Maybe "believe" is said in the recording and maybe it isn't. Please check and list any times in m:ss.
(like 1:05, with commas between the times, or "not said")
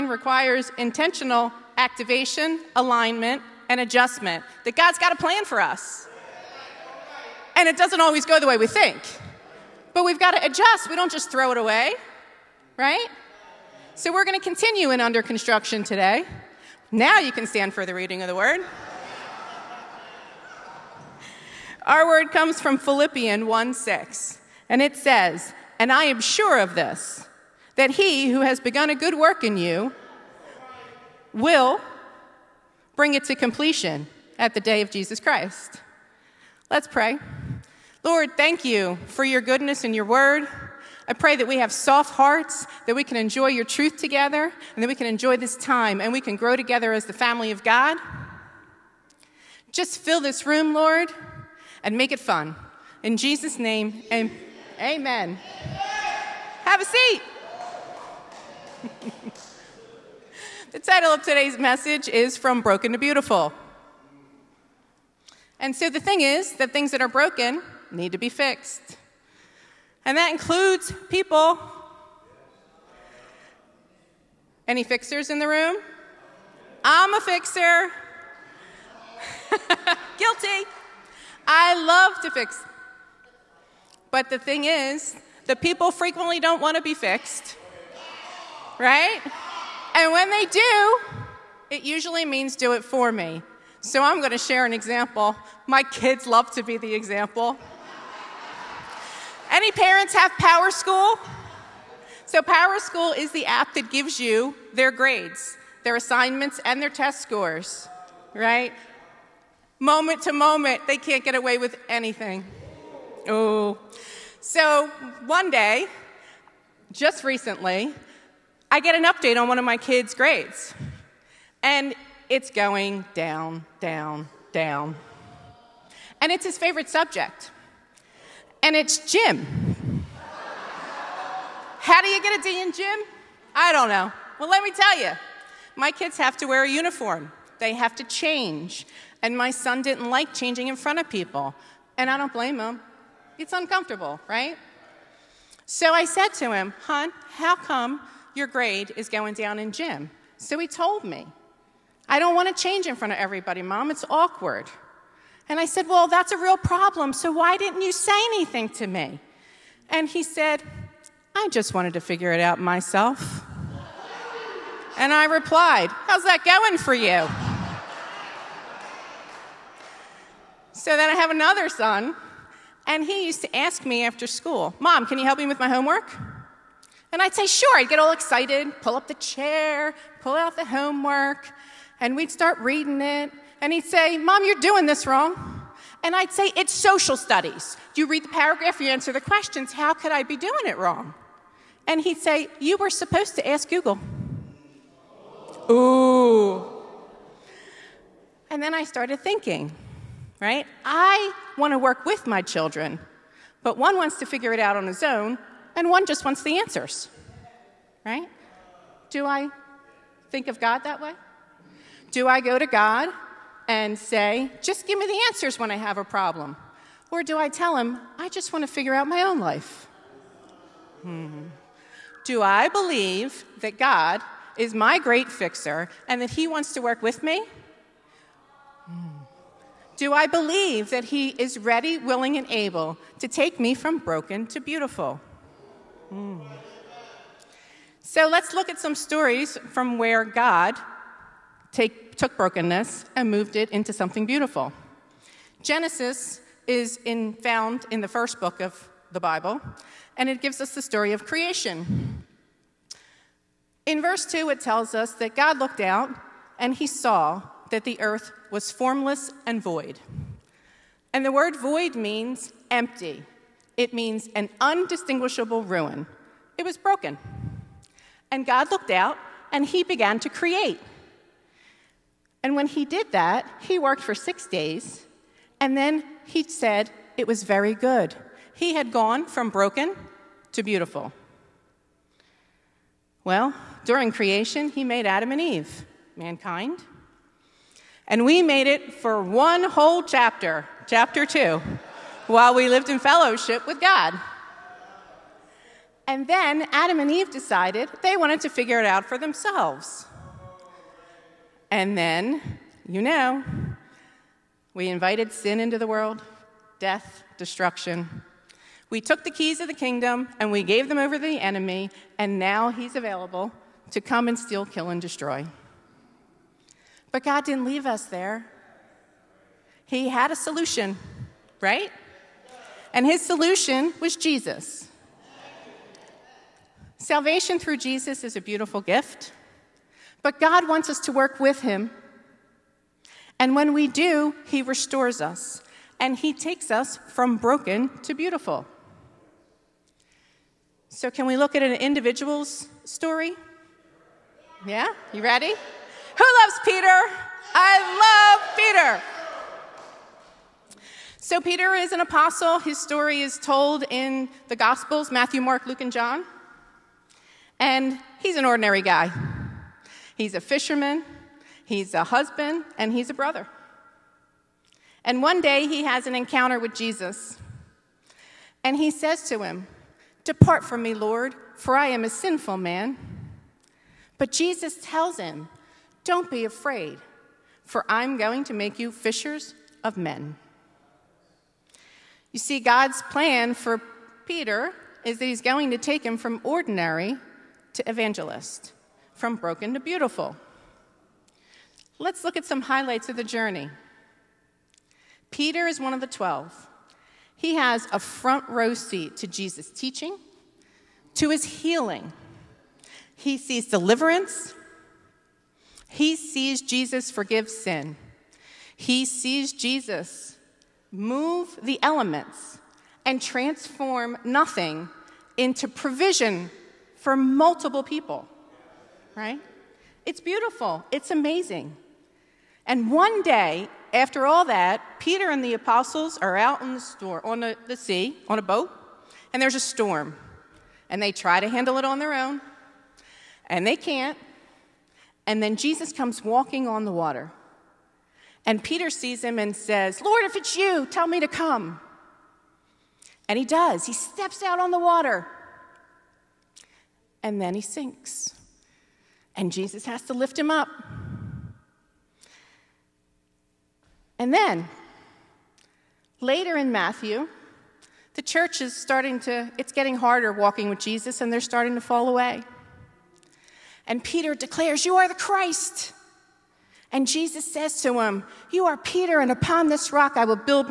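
3:42, 3:50.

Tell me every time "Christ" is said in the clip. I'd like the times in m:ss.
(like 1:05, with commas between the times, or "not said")
0:35, 7:45.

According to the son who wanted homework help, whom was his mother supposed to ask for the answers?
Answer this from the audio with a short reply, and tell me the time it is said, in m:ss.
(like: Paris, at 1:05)
Google, at 3:13.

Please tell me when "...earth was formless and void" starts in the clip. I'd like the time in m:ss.
4:18.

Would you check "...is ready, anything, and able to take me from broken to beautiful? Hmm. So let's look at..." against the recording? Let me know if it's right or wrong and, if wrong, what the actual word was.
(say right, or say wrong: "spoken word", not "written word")
wrong: "willing", not "anything".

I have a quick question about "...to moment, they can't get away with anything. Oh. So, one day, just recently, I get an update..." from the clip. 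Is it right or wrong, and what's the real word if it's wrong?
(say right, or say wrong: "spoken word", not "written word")
right.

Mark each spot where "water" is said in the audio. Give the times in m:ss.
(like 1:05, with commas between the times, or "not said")
7:16, 7:24.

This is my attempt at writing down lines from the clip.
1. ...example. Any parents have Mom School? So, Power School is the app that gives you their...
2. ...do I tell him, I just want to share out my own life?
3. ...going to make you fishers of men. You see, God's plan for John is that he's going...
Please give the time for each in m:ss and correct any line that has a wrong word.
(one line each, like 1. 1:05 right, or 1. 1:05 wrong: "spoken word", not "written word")
1. 1:36 wrong: "Power", not "Mom"
2. 3:37 wrong: "figure", not "share"
3. 6:18 wrong: "Peter", not "John".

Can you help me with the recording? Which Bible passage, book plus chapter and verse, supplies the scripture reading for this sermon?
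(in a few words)
Philippians 1:6.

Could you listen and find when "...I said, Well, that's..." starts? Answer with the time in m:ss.
2:35.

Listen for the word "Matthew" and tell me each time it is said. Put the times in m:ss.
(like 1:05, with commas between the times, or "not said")
5:55, 7:36.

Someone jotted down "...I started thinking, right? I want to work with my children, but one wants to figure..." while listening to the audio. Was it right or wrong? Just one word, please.
right.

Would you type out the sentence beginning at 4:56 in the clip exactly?
And then Adam and Eve decided they wanted to figure it out for themselves.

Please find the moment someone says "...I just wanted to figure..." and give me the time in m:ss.
2:41.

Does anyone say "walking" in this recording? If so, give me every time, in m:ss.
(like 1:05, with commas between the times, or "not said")
7:16, 7:40.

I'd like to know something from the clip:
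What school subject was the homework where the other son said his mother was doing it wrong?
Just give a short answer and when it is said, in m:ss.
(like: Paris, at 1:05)
Social studies, at 3:06.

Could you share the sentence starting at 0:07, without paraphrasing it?
And it doesn't always go the way we think.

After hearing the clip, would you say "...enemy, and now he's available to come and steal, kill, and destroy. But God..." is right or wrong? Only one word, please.
right.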